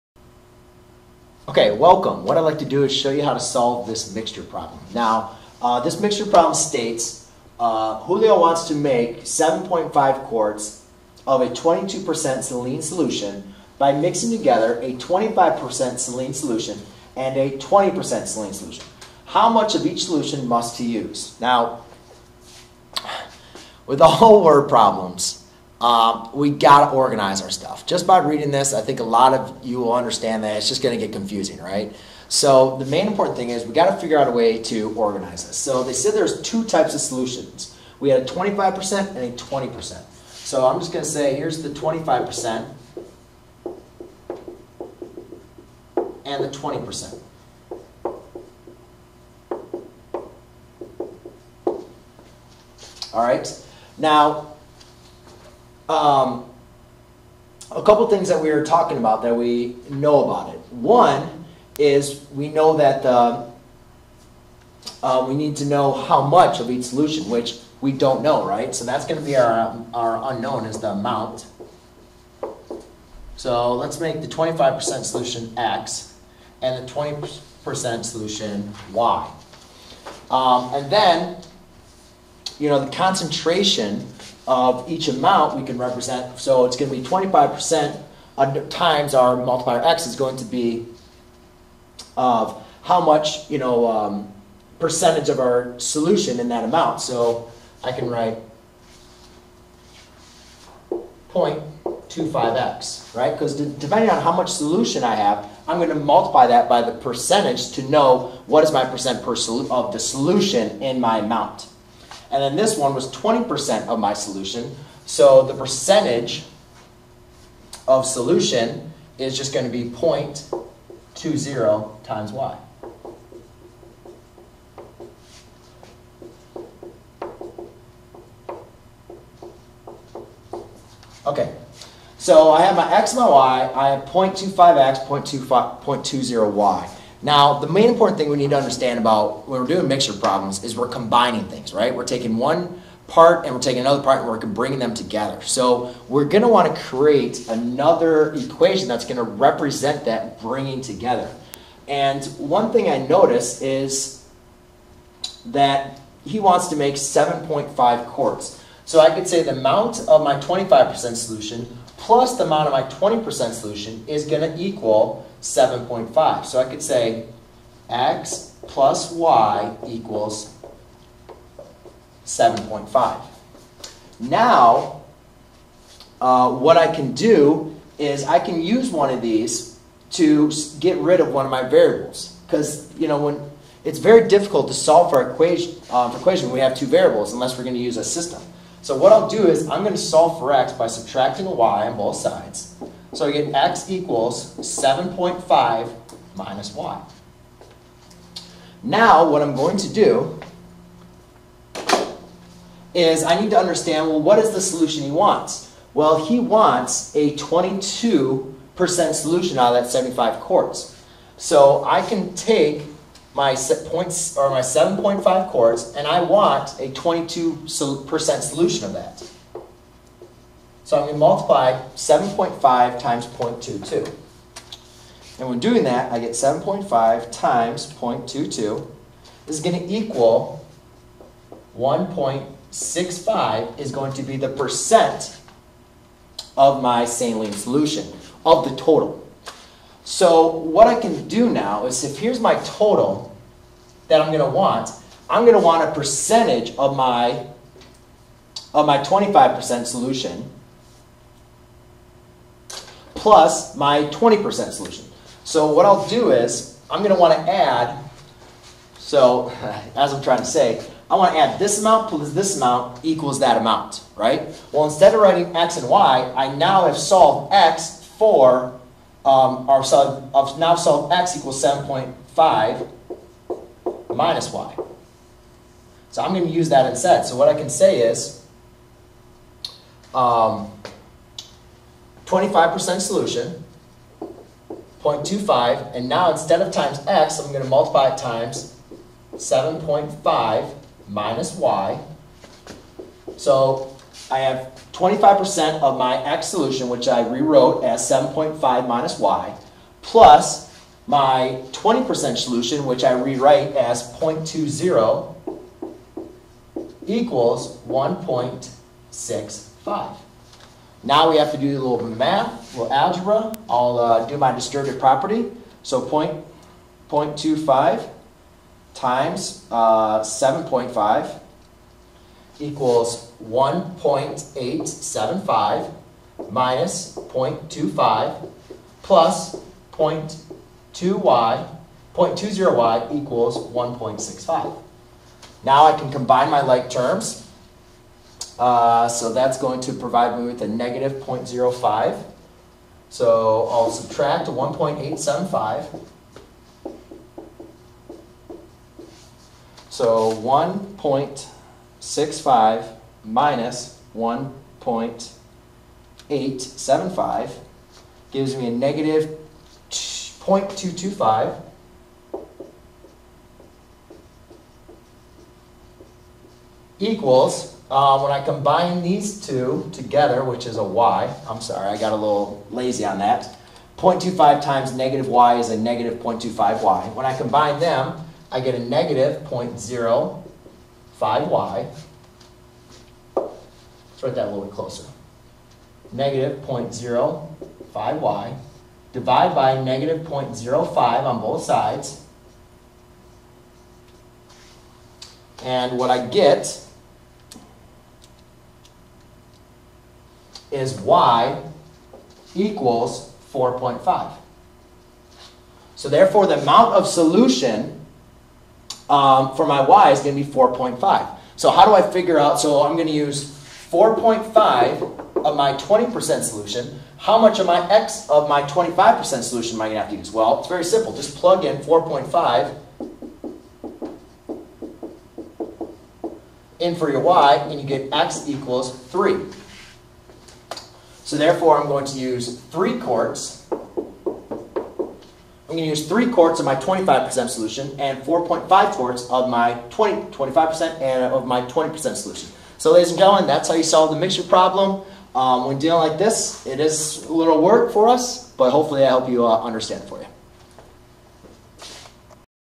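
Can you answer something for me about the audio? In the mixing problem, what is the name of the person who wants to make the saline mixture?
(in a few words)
Julio.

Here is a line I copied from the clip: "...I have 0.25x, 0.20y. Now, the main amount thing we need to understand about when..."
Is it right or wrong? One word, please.
wrong.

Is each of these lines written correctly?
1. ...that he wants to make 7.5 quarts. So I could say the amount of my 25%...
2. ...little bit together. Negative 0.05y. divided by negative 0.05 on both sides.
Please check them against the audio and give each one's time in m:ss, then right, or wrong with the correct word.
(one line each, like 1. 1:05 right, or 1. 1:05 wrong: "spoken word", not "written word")
1. 2:35 right
2. 6:24 wrong: "closer", not "together".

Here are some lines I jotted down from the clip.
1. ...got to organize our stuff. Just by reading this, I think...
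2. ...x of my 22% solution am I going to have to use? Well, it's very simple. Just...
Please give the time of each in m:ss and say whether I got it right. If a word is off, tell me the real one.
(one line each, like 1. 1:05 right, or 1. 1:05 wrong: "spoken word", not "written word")
1. 0:26 right
2. 6:57 wrong: "25", not "22".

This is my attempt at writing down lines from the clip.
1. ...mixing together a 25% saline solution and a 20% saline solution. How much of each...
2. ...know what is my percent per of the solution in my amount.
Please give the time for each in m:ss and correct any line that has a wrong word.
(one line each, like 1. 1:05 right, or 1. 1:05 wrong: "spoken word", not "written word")
1. 0:13 right
2. 1:47 right.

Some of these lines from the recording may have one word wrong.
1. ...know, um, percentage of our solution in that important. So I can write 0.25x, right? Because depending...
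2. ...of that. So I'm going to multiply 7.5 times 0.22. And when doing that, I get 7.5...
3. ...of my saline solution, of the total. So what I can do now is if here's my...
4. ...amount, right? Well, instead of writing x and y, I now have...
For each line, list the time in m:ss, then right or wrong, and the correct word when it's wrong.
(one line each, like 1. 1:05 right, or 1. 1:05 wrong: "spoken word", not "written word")
1. 1:33 wrong: "amount", not "important"
2. 3:38 right
3. 3:56 right
4. 4:23 right.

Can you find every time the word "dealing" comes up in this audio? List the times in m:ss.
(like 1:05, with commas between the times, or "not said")
7:25.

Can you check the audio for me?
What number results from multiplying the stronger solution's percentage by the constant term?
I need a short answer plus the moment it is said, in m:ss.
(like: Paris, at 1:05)
1.875, at 5:23.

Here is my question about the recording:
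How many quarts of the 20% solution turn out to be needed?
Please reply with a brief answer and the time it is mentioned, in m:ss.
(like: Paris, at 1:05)
4.5, at 6:41.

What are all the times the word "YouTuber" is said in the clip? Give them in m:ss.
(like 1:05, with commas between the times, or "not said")
not said.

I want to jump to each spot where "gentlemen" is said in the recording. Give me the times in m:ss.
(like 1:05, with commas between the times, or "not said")
7:23.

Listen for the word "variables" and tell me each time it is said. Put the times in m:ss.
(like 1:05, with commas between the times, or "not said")
3:01, 3:06.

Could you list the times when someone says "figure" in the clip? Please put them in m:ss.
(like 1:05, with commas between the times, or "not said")
0:33, 6:52.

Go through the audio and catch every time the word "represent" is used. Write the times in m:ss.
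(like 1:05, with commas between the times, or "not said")
1:25, 2:29.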